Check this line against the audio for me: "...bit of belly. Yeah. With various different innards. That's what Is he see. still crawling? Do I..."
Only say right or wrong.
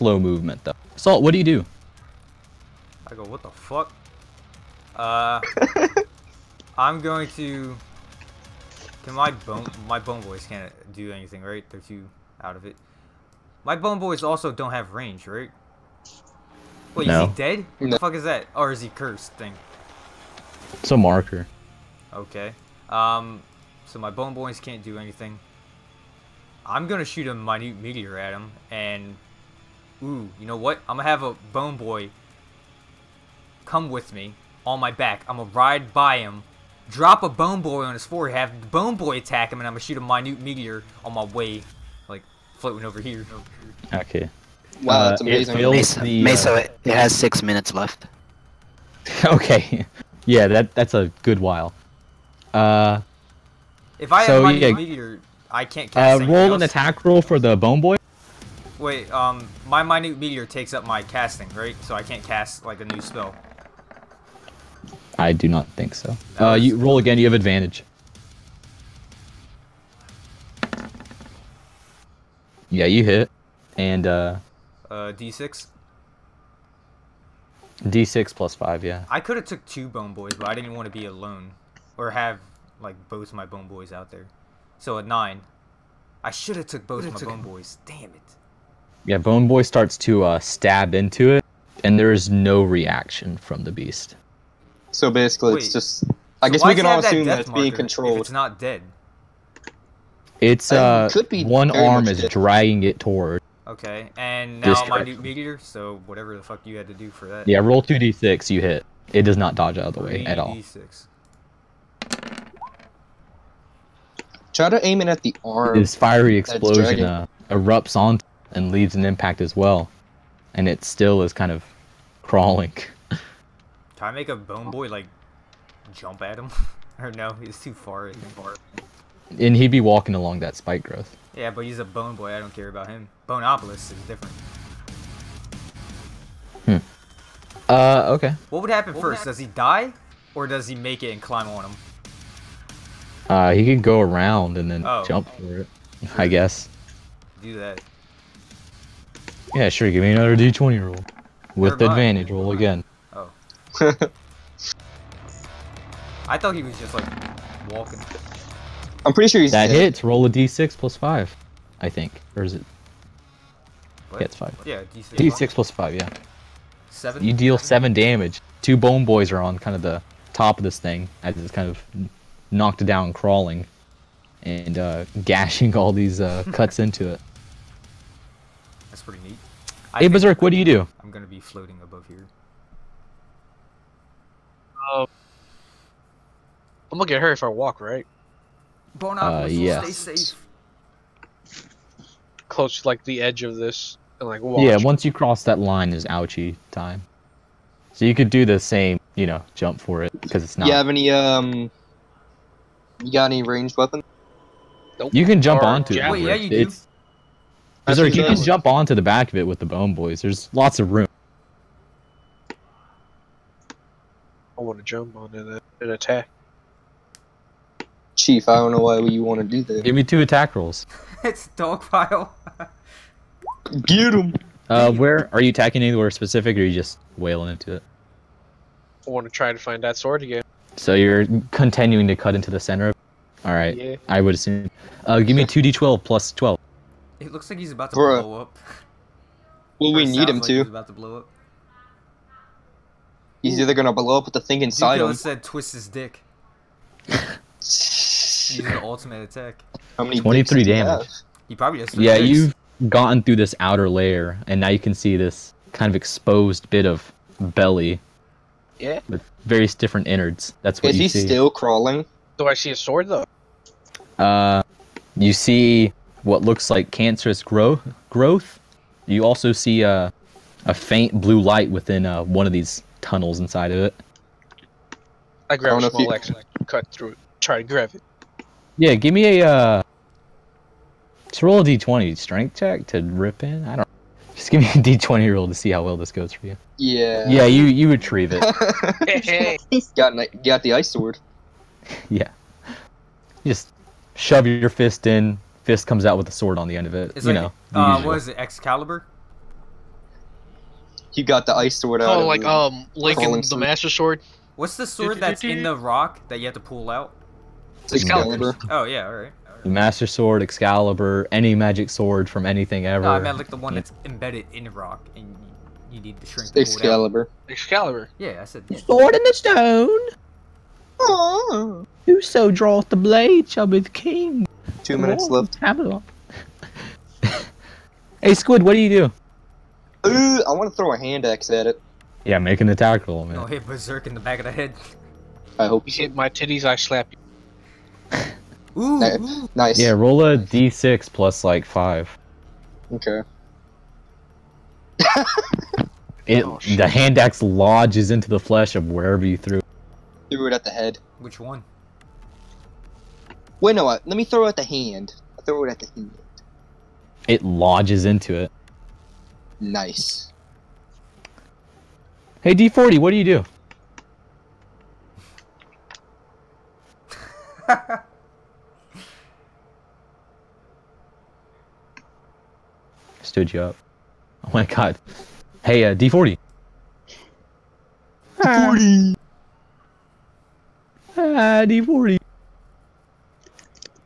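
right.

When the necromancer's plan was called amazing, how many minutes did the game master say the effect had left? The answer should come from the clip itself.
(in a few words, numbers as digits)
6.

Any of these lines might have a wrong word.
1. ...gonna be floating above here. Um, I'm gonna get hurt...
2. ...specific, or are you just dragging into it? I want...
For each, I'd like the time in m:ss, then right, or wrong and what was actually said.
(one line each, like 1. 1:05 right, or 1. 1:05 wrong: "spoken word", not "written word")
1. 3:01 right
2. 3:46 wrong: "wailing", not "dragging".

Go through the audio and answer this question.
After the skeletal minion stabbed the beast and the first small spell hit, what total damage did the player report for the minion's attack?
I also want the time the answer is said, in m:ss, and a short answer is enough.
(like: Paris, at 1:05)
9, at 1:24.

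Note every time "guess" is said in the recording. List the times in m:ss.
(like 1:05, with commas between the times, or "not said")
1:36, 2:26.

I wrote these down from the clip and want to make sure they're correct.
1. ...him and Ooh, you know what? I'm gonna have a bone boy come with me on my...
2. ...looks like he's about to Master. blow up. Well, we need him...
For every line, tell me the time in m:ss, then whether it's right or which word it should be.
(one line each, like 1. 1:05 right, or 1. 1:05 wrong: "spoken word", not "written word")
1. 0:28 right
2. 3:57 wrong: "Bruh", not "Master".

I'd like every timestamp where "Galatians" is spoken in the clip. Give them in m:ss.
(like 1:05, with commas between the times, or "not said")
not said.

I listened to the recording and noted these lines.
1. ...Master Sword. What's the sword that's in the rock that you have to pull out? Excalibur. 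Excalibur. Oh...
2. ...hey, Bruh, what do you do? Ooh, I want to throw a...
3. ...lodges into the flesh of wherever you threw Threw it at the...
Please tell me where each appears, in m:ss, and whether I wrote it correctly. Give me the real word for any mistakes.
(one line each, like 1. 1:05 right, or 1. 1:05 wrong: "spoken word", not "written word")
1. 5:03 right
2. 5:28 wrong: "Squid", not "Bruh"
3. 5:47 right.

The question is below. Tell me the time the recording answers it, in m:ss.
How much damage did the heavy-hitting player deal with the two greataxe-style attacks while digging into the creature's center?
4:10.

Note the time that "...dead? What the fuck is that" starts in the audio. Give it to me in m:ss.
0:17.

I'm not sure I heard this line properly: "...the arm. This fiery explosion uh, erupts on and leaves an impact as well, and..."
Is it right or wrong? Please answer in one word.
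right.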